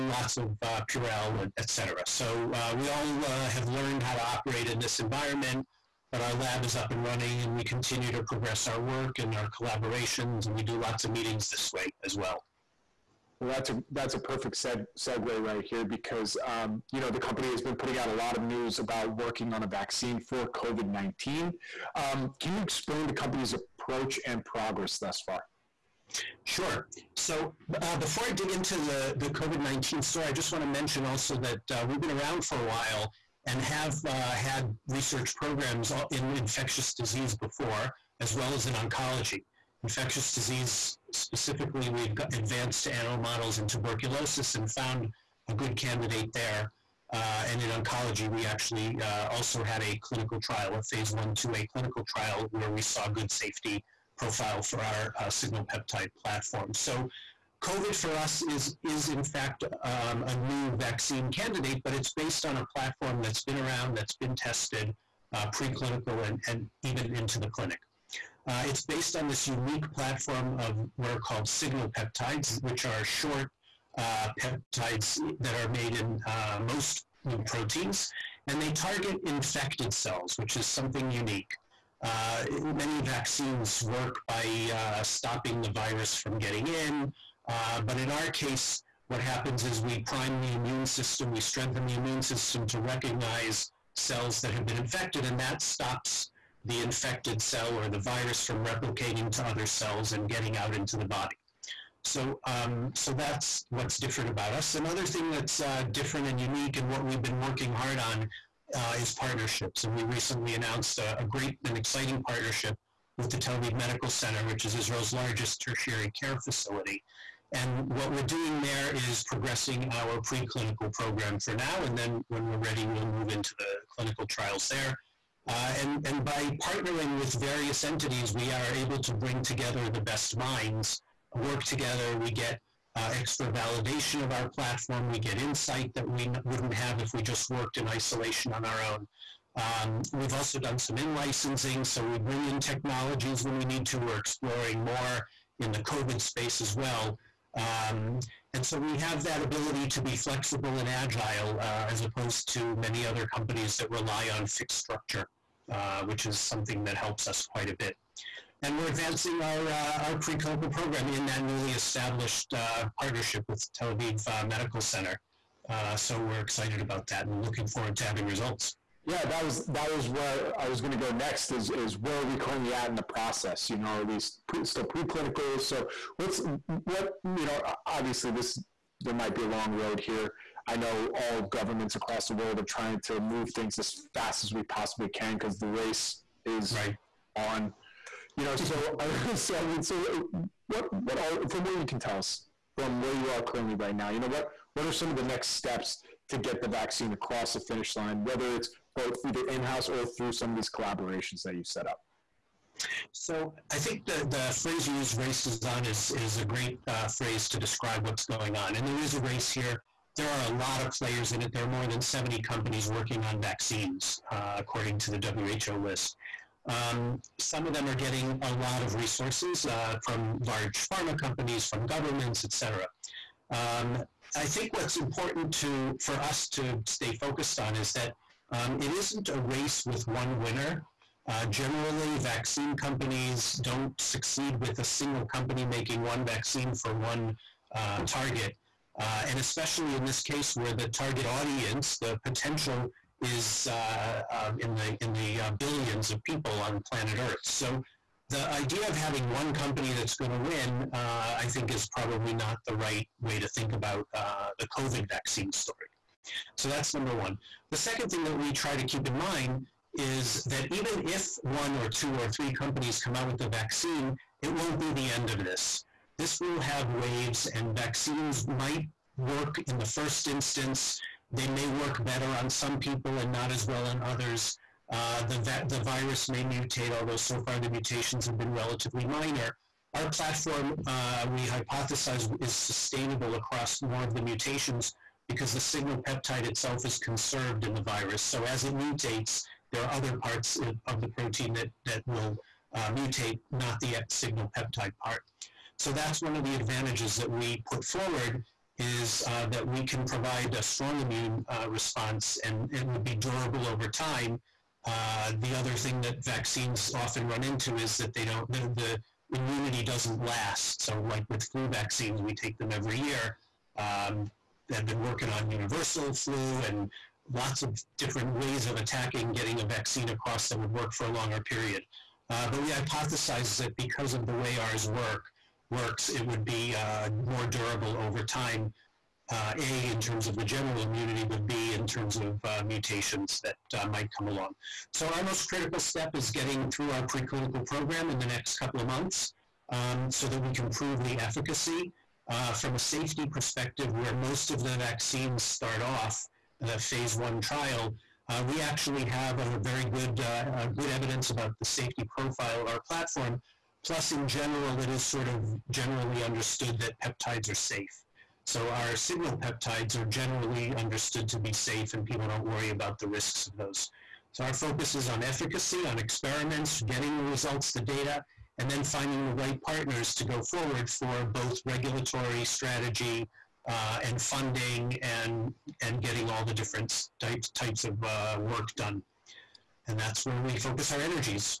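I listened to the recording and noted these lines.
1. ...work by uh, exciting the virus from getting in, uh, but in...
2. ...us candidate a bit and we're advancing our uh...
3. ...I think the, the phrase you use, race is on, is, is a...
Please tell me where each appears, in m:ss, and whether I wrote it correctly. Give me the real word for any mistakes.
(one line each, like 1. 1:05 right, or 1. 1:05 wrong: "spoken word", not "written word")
1. 1:23 wrong: "stopping", not "exciting"
2. 2:37 wrong: "quite", not "candidate"
3. 3:23 right.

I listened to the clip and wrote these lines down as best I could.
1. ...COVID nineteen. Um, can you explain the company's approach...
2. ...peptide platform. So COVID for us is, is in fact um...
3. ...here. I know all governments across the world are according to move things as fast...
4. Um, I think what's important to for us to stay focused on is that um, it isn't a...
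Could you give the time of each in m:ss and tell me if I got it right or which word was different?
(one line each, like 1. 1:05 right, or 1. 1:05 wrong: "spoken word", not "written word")
1. 0:20 right
2. 0:55 right
3. 2:59 wrong: "trying", not "according"
4. 3:43 right.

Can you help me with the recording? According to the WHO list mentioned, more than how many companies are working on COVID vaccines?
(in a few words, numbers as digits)
70.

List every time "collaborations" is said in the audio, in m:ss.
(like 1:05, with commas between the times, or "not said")
0:09, 3:20.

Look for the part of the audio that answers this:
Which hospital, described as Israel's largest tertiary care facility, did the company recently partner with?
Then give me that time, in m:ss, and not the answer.
1:53.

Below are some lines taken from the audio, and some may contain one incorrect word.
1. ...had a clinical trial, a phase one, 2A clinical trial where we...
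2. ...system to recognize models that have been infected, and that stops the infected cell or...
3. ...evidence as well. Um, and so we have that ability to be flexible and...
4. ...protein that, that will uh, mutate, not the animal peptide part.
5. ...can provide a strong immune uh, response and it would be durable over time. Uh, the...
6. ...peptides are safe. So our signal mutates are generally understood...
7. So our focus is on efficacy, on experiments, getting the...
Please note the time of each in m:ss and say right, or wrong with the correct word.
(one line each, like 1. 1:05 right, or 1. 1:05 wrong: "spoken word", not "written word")
1. 0:49 right
2. 1:32 wrong: "cells", not "models"
3. 2:26 wrong: "space", not "evidence"
4. 4:51 wrong: "signal", not "animal"
5. 4:59 right
6. 5:57 wrong: "peptides", not "mutates"
7. 6:04 right.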